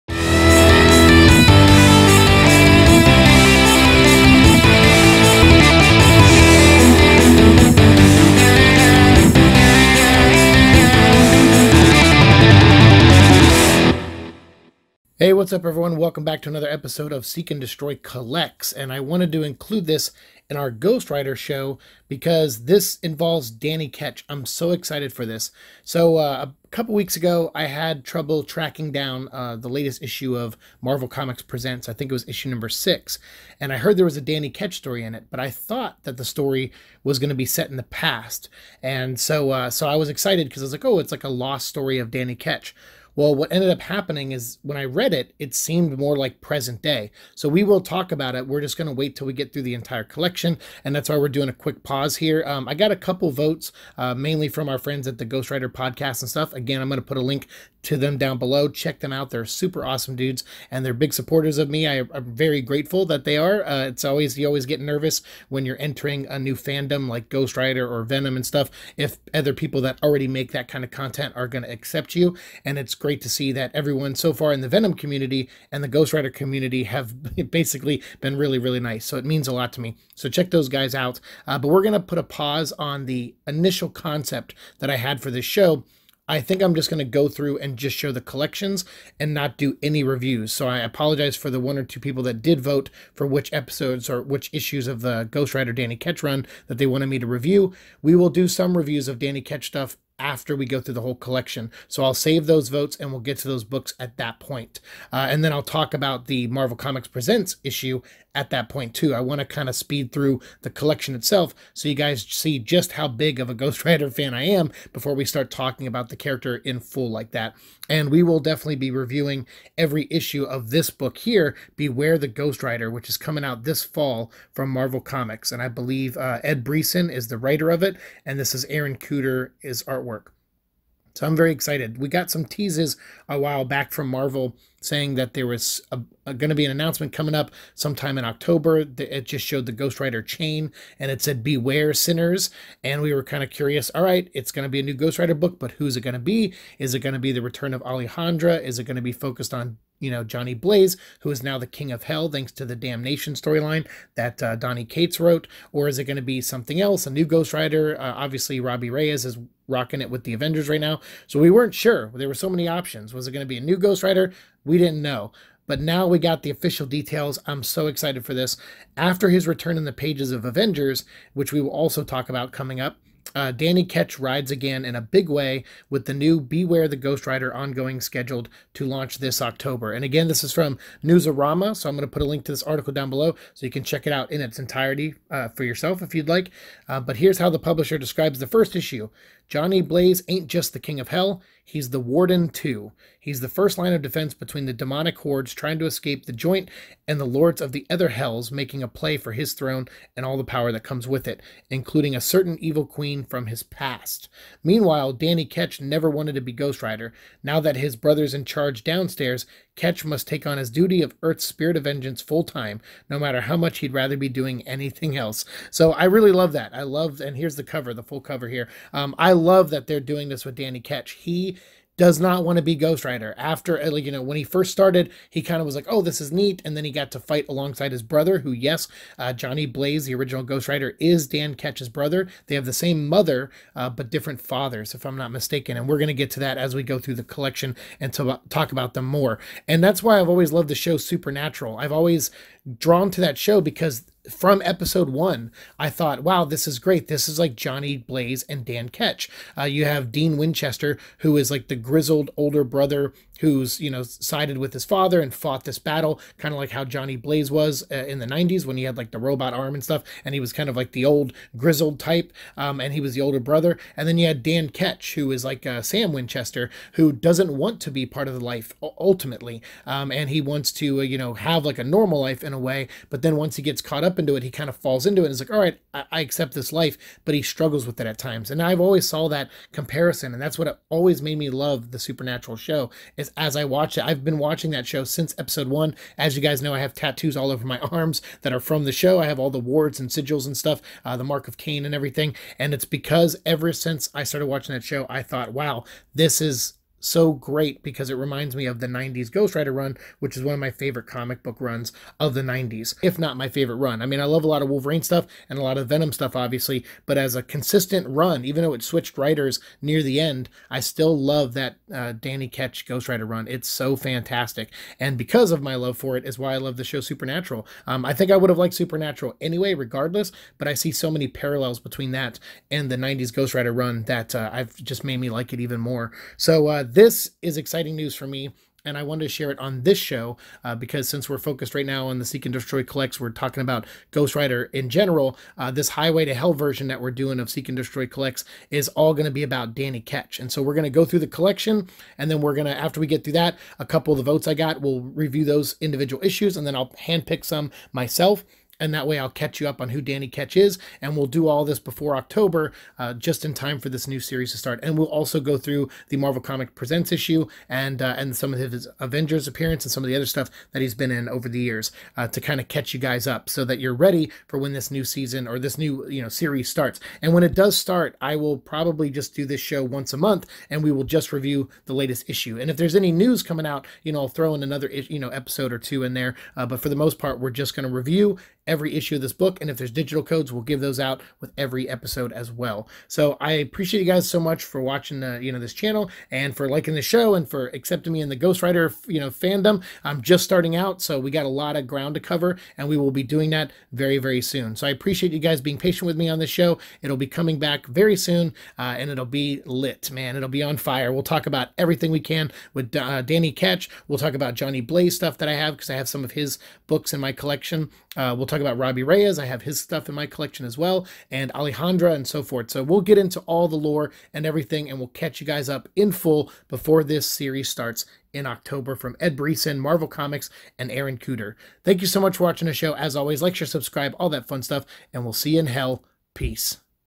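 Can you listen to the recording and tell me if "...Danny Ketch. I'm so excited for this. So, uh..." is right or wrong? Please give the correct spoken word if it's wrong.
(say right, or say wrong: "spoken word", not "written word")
right.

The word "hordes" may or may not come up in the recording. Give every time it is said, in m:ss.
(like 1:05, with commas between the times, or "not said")
3:15.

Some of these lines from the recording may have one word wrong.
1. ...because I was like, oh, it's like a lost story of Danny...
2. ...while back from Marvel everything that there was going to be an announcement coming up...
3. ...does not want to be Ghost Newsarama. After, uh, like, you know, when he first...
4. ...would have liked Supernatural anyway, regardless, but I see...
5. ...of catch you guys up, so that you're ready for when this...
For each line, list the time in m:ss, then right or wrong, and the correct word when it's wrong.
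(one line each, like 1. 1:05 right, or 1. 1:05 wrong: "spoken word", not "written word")
1. 0:40 right
2. 2:13 wrong: "saying", not "everything"
3. 3:41 wrong: "Rider", not "Newsarama"
4. 5:18 right
5. 6:02 right.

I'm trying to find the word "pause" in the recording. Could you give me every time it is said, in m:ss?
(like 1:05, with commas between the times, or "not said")
0:51, 1:22.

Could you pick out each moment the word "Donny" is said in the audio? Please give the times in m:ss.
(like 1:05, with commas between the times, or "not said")
2:34.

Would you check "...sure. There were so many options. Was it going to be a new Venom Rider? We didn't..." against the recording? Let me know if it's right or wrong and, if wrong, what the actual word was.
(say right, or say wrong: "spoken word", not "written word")
wrong: "Ghost", not "Venom".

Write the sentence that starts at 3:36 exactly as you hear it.
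I love, and here's the cover, the full cover here.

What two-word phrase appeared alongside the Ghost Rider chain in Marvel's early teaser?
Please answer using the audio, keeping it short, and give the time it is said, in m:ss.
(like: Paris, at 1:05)
Beware Sinners, at 2:21.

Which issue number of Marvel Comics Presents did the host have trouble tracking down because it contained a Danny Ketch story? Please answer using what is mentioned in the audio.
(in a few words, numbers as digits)
6.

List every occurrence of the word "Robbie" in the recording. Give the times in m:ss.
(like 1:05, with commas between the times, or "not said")
2:38, 6:48.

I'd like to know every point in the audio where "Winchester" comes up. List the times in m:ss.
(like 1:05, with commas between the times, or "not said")
4:10, 4:26.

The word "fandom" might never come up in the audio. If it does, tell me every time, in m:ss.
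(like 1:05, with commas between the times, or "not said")
1:06, 6:29.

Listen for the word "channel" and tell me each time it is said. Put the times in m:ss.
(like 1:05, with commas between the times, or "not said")
6:25.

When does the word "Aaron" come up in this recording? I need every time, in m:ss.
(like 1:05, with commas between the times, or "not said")
2:08, 7:00.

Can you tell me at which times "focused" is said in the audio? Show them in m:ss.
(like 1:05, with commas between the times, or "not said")
2:29, 5:31.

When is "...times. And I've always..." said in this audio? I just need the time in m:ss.
4:38.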